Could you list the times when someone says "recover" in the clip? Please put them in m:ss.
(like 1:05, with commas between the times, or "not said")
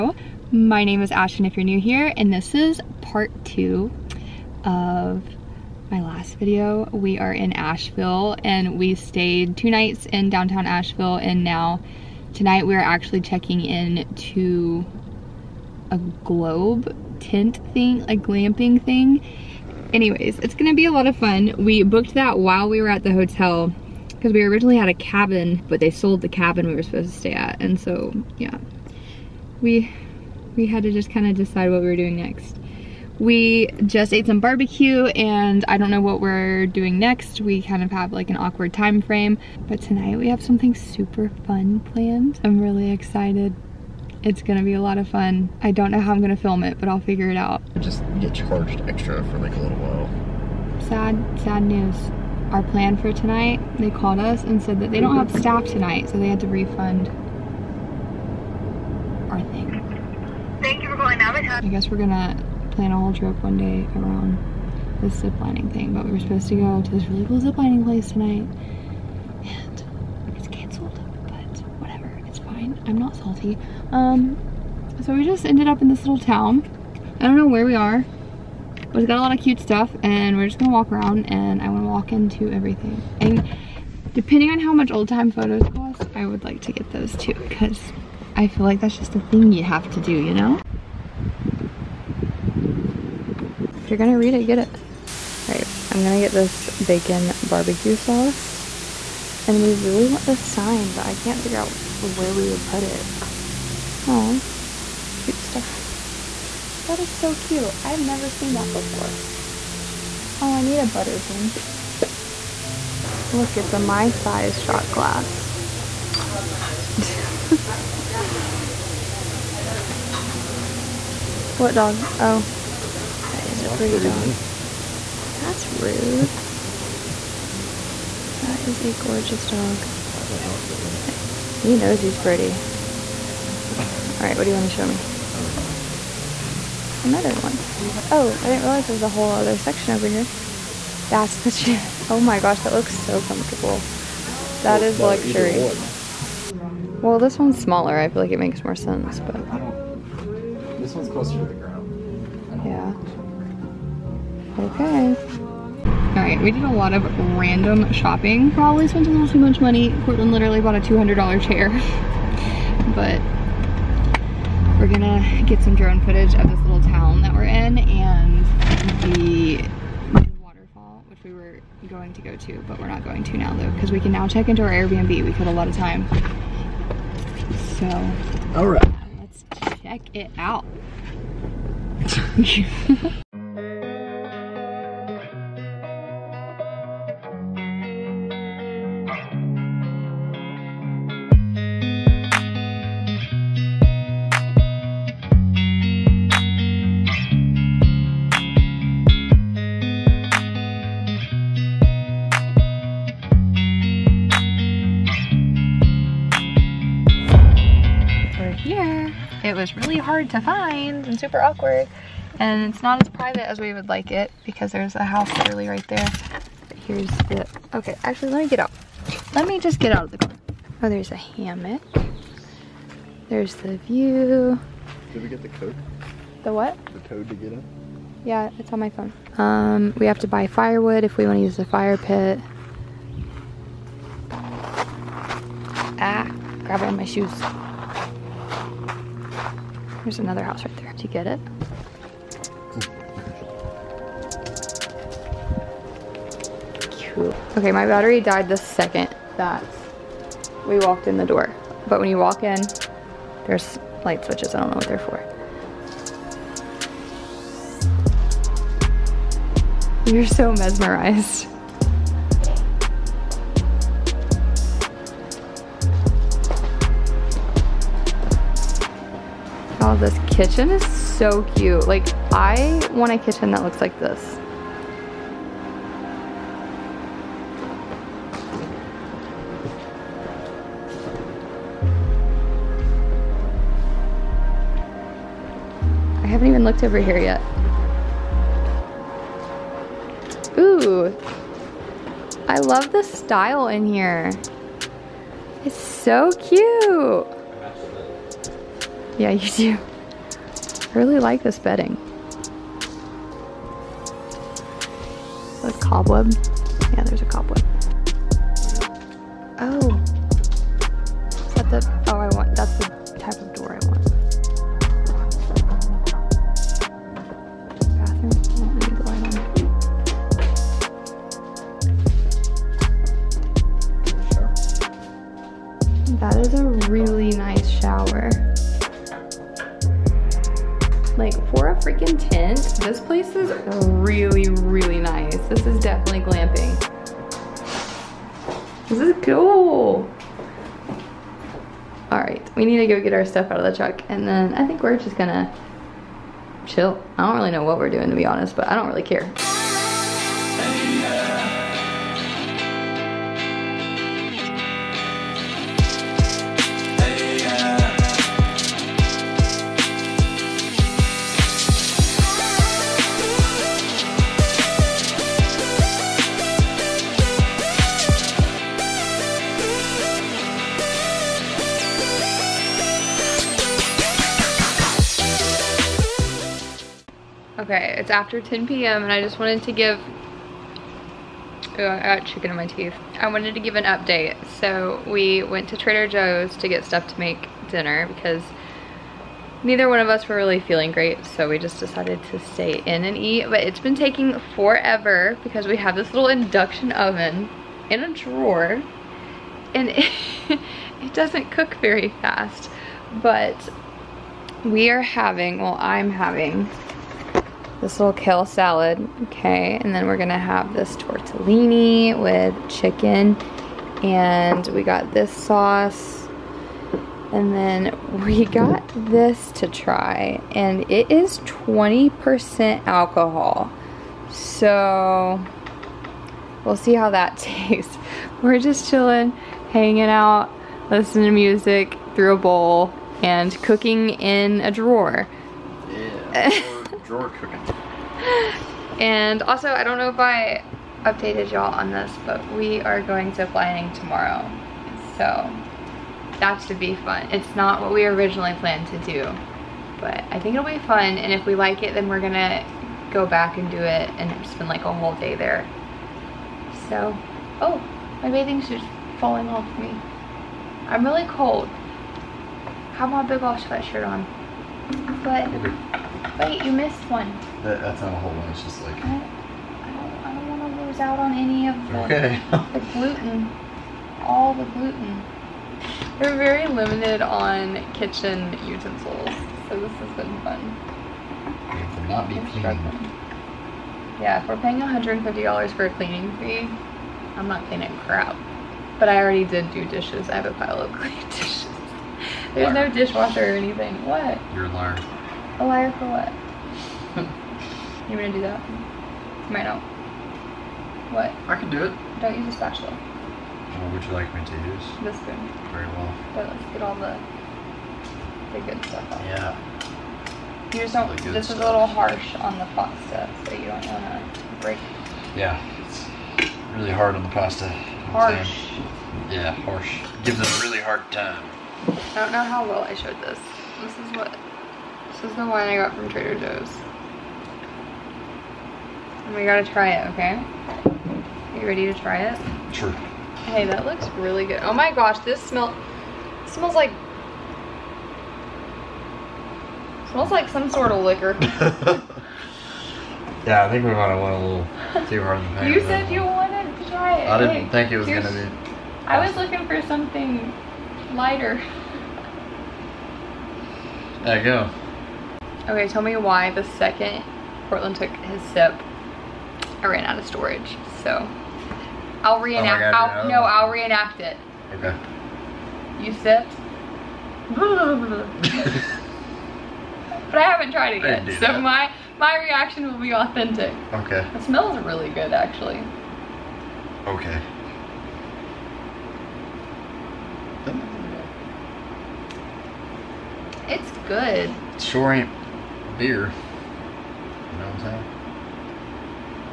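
not said.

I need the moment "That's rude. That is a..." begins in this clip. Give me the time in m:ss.
2:05.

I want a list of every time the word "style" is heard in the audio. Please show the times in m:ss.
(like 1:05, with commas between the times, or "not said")
4:53.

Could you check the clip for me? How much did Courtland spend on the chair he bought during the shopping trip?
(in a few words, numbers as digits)
$200.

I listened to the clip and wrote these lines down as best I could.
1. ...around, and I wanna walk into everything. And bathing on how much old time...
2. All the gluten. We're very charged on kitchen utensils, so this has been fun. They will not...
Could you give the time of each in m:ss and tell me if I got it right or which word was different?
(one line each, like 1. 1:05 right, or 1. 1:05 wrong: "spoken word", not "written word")
1. 1:20 wrong: "depending", not "bathing"
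2. 7:54 wrong: "limited", not "charged".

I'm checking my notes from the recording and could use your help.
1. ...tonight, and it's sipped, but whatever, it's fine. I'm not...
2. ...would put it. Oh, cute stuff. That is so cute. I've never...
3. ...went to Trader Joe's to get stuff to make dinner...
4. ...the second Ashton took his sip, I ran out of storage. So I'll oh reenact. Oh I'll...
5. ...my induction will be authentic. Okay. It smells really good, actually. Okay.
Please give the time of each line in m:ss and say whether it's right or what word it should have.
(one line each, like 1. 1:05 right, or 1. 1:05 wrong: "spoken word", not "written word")
1. 1:08 wrong: "canceled", not "sipped"
2. 1:42 right
3. 6:25 right
4. 9:16 wrong: "Courtland", not "Ashton"
5. 9:32 wrong: "reaction", not "induction".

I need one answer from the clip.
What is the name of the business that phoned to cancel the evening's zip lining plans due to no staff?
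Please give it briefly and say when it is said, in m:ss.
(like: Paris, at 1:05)
Navitat, at 1:01.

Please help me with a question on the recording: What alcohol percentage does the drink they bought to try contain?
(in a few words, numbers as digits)
20%.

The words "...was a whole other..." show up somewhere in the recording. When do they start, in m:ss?
2:18.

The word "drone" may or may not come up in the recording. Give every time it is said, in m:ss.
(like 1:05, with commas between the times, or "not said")
2:45.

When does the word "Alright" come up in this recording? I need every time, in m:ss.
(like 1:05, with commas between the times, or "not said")
1:35.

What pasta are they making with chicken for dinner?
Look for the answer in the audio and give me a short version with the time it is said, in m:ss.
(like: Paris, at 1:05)
tortellini, at 6:50.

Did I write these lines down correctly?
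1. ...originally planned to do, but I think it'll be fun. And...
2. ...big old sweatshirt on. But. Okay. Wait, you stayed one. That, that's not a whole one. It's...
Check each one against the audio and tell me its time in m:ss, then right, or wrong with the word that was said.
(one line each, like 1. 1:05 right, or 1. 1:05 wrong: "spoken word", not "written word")
1. 7:28 right
2. 7:43 wrong: "missed", not "stayed".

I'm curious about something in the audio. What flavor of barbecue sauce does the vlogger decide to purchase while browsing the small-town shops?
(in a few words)
bacon.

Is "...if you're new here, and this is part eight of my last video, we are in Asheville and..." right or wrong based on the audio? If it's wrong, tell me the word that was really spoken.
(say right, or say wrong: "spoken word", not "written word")
wrong: "two", not "eight".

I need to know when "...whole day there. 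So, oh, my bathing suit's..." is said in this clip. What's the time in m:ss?
7:34.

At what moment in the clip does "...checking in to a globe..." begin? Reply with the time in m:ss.
0:13.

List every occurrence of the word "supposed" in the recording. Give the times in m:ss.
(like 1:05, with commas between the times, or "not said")
0:26, 1:06.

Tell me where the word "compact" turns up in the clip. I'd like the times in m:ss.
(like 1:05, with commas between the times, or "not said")
not said.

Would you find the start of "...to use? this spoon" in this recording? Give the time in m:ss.
8:24.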